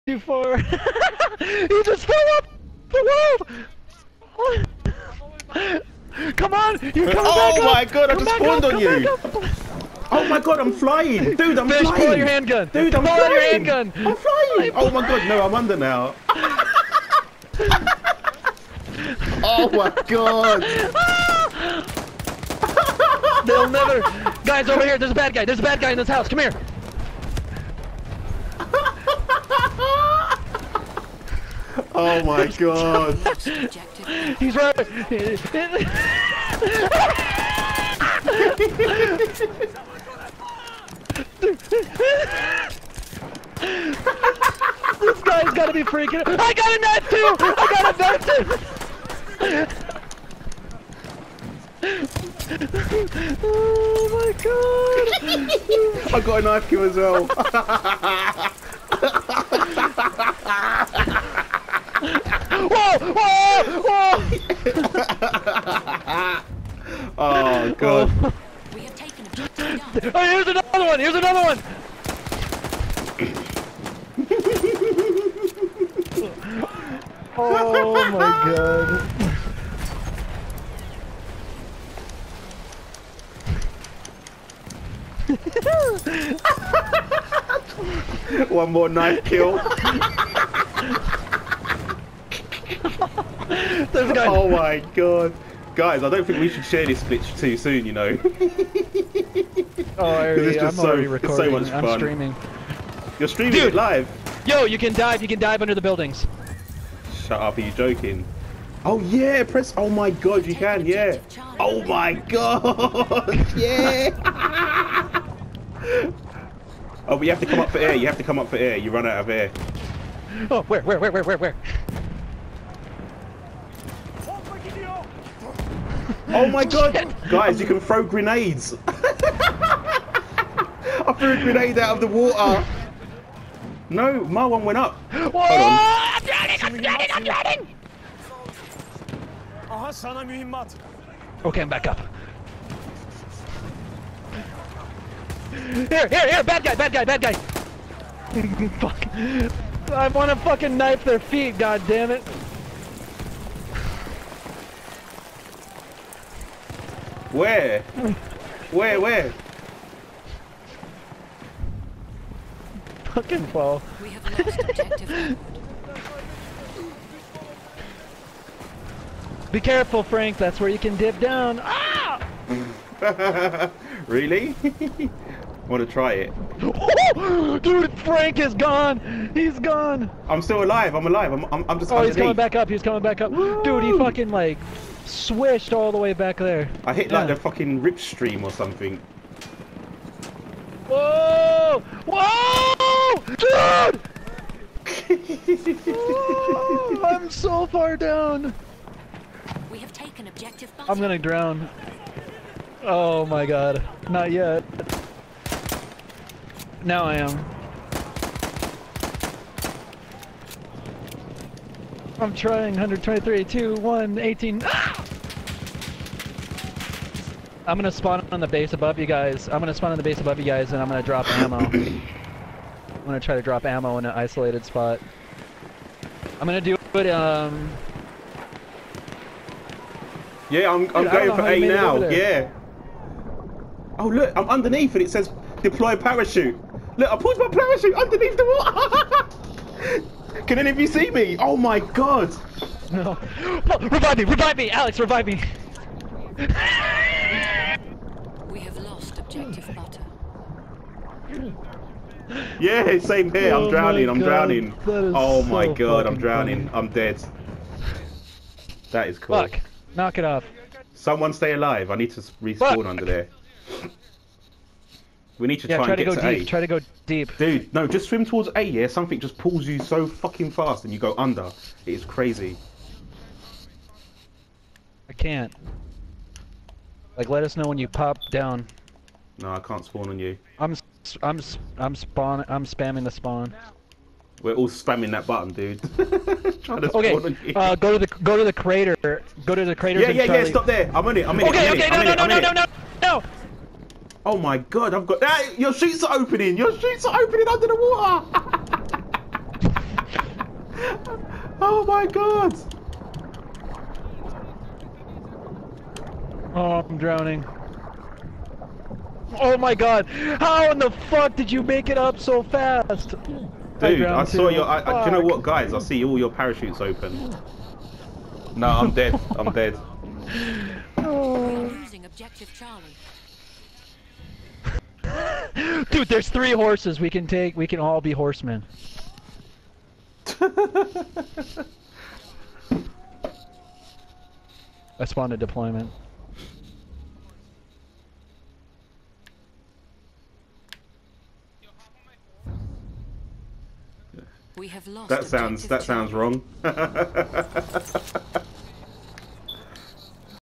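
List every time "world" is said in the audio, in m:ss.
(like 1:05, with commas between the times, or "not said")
0:04.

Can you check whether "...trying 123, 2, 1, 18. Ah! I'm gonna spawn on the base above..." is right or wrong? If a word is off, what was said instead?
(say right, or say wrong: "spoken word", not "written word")
right.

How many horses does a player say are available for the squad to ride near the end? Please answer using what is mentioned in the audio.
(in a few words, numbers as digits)
3.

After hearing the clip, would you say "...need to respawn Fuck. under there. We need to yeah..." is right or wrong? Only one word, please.
right.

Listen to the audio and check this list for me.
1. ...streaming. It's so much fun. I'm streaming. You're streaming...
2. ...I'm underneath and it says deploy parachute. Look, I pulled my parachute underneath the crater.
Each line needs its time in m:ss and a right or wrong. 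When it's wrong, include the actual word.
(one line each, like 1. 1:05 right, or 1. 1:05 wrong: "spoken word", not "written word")
1. 1:41 wrong: "recording", not "streaming"
2. 3:54 wrong: "water", not "crater".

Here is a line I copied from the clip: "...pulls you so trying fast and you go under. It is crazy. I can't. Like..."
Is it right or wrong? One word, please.
wrong.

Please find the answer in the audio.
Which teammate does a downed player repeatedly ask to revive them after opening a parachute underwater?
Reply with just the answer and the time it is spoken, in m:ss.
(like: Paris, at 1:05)
Alex, at 4:04.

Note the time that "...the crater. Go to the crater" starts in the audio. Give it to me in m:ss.
4:48.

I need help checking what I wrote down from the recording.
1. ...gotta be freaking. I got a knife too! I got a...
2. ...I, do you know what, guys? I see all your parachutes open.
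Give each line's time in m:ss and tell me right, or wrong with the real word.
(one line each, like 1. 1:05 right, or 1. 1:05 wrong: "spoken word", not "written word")
1. 0:45 right
2. 5:14 right.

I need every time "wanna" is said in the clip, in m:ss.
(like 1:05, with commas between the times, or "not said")
2:30.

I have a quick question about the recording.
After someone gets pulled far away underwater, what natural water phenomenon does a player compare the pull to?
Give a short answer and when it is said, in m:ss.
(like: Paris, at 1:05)
Rip stream, at 3:07.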